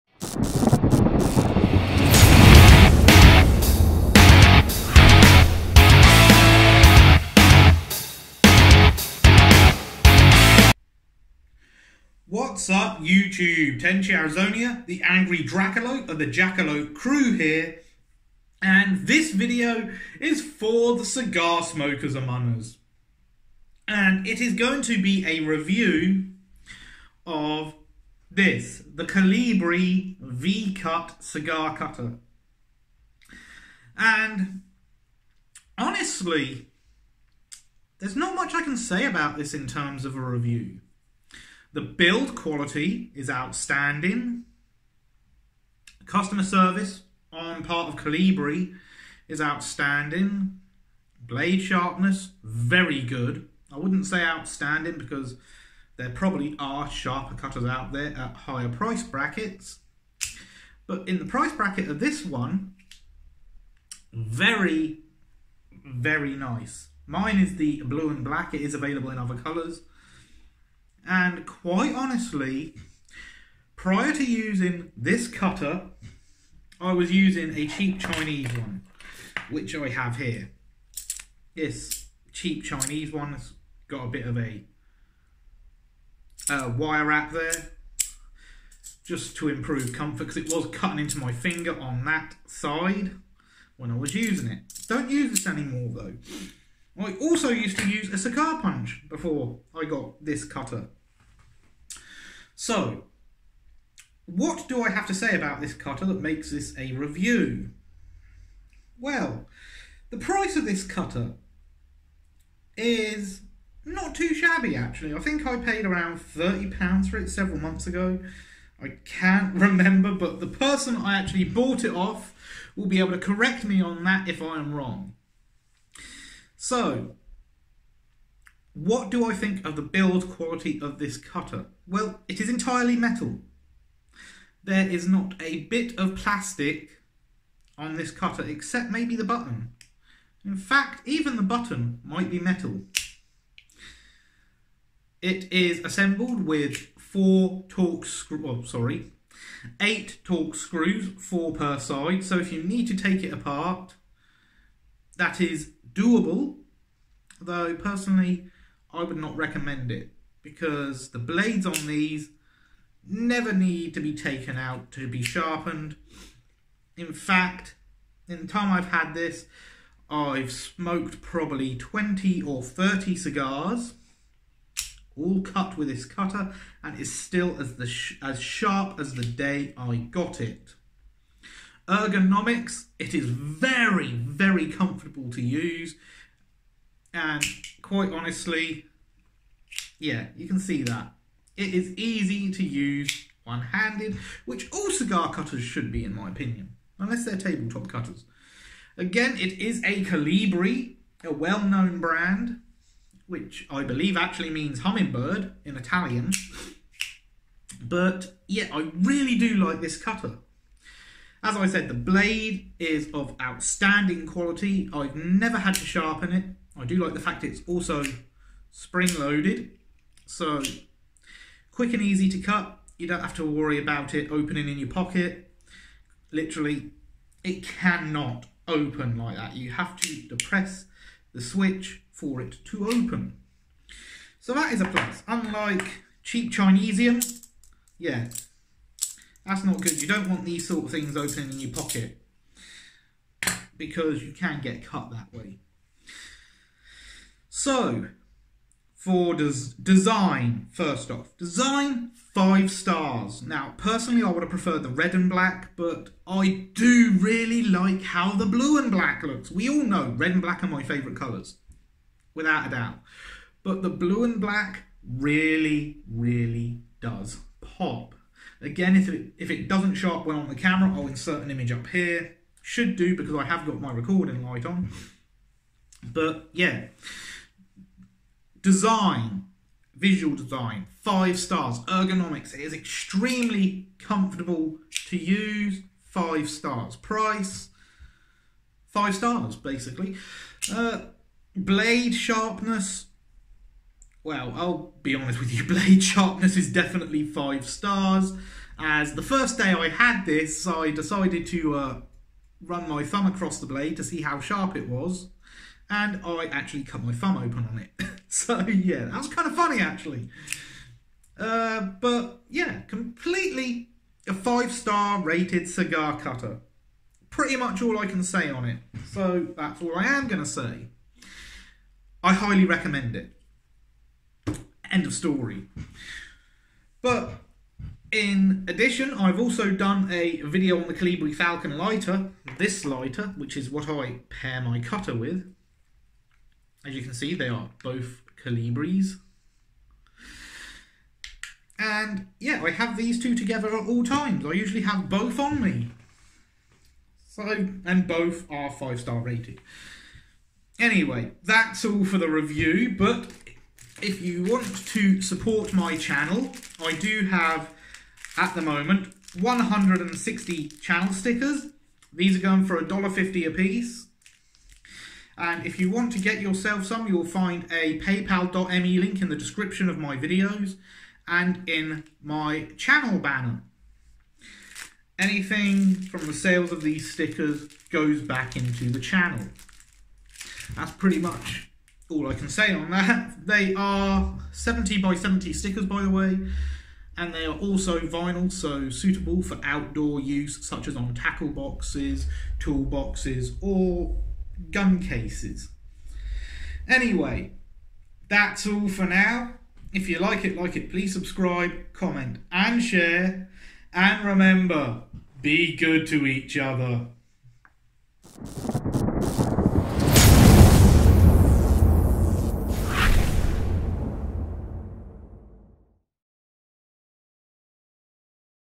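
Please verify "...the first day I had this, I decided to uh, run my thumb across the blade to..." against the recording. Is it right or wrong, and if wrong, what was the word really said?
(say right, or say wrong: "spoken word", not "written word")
right.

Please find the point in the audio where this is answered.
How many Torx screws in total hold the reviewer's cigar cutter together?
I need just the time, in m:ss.
2:29.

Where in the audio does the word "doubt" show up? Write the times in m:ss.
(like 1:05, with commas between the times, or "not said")
4:22.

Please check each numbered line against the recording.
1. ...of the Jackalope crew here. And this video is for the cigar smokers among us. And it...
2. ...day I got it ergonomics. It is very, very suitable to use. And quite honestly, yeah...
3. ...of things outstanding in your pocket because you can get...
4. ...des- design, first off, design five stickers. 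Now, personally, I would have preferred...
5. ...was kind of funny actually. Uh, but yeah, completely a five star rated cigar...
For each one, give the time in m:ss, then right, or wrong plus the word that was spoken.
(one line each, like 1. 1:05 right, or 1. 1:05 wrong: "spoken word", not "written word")
1. 0:16 right
2. 2:59 wrong: "comfortable", not "suitable"
3. 4:00 wrong: "opening", not "outstanding"
4. 4:09 wrong: "stars", not "stickers"
5. 5:09 right.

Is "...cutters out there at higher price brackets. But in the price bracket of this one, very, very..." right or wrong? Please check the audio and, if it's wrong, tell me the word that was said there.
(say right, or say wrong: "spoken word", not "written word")
right.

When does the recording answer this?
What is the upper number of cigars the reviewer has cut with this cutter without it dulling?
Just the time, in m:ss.
2:51.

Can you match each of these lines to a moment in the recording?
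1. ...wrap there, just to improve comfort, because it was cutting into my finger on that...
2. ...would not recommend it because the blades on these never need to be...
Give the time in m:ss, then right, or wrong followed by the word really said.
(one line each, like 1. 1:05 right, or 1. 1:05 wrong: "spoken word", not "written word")
1. 1:27 right
2. 2:39 right.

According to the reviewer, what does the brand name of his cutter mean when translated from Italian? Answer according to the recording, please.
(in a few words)
hummingbird.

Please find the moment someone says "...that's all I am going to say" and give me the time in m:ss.
5:19.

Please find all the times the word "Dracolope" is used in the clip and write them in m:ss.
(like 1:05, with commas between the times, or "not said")
0:15.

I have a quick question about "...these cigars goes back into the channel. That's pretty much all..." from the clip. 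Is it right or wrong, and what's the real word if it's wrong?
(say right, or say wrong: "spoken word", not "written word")
wrong: "stickers", not "cigars".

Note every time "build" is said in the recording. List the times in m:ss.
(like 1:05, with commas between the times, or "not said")
0:41, 2:09.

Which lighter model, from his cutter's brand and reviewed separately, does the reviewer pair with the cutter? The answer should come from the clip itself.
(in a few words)
Colibri Falcon.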